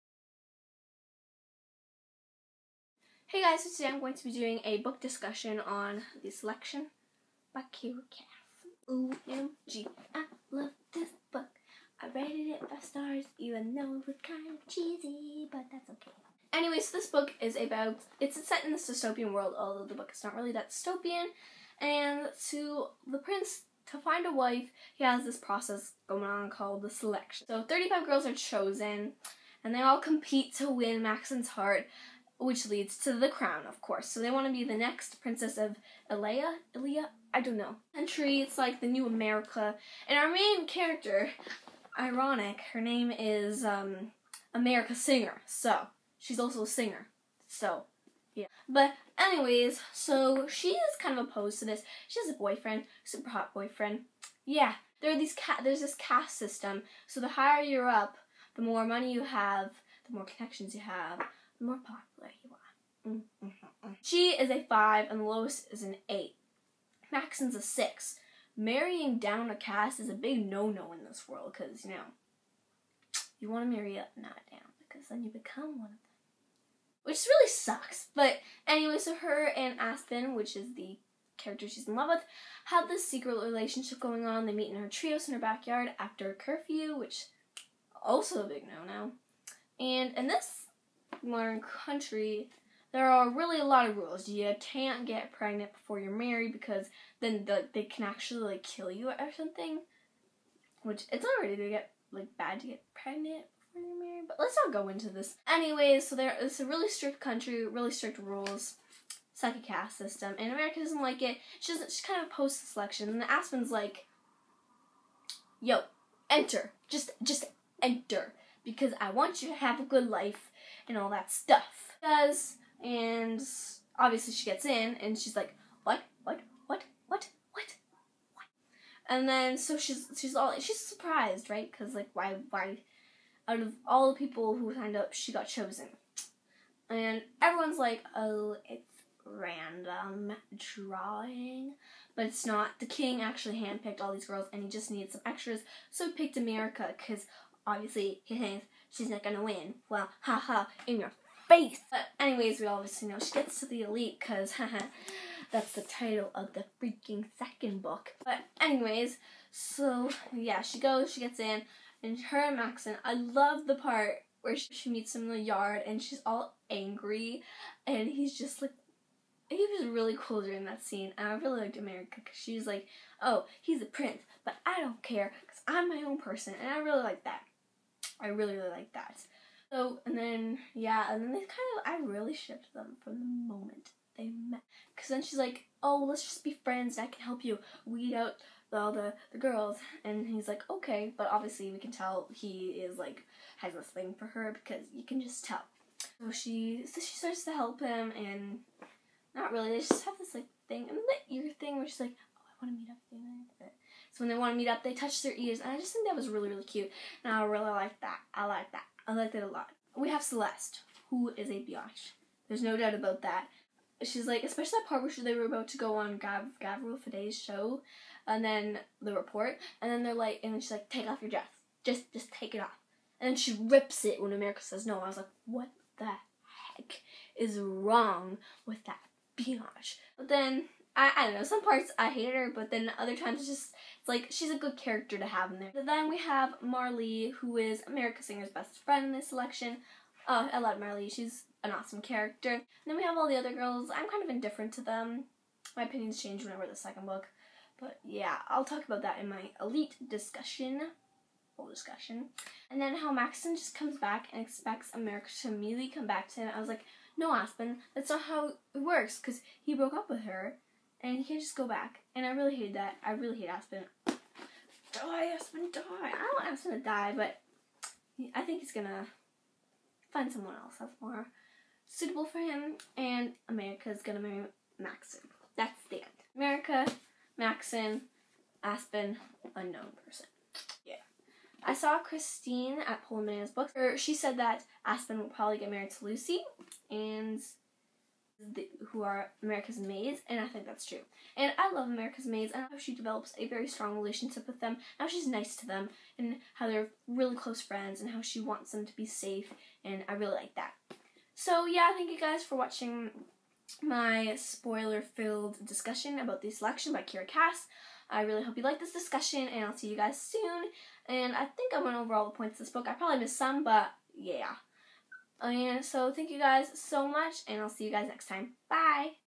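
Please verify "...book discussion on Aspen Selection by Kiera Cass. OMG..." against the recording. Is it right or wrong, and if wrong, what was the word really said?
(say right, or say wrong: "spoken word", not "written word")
wrong: "The", not "Aspen".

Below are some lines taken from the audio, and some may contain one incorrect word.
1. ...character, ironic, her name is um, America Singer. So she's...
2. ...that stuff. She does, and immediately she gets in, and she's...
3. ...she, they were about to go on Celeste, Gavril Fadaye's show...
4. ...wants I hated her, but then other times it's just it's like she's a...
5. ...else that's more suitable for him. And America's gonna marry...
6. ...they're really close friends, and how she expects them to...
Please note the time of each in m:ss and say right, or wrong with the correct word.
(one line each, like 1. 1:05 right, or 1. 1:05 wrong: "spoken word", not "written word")
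1. 0:40 right
2. 2:01 wrong: "obviously", not "immediately"
3. 3:35 wrong: "Gav", not "Celeste"
4. 3:51 wrong: "parts", not "wants"
5. 4:30 right
6. 4:56 wrong: "wants", not "expects".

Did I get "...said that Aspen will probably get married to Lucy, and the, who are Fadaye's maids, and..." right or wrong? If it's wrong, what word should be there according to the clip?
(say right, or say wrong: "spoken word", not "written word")
wrong: "America", not "Fadaye".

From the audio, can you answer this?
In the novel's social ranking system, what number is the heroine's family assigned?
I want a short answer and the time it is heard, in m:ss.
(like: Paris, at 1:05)
5, at 1:04.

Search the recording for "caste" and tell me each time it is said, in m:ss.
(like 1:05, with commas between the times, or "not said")
0:55, 1:09, 1:49.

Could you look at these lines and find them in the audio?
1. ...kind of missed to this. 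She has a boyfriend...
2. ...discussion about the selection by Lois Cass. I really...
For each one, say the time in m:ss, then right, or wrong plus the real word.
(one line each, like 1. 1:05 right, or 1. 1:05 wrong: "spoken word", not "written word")
1. 0:50 wrong: "opposed", not "missed"
2. 5:05 wrong: "Kiera", not "Lois".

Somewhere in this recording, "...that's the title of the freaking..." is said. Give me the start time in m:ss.
2:35.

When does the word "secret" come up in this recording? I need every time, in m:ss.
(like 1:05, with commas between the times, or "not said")
1:23.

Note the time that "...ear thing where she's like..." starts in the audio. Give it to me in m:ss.
3:21.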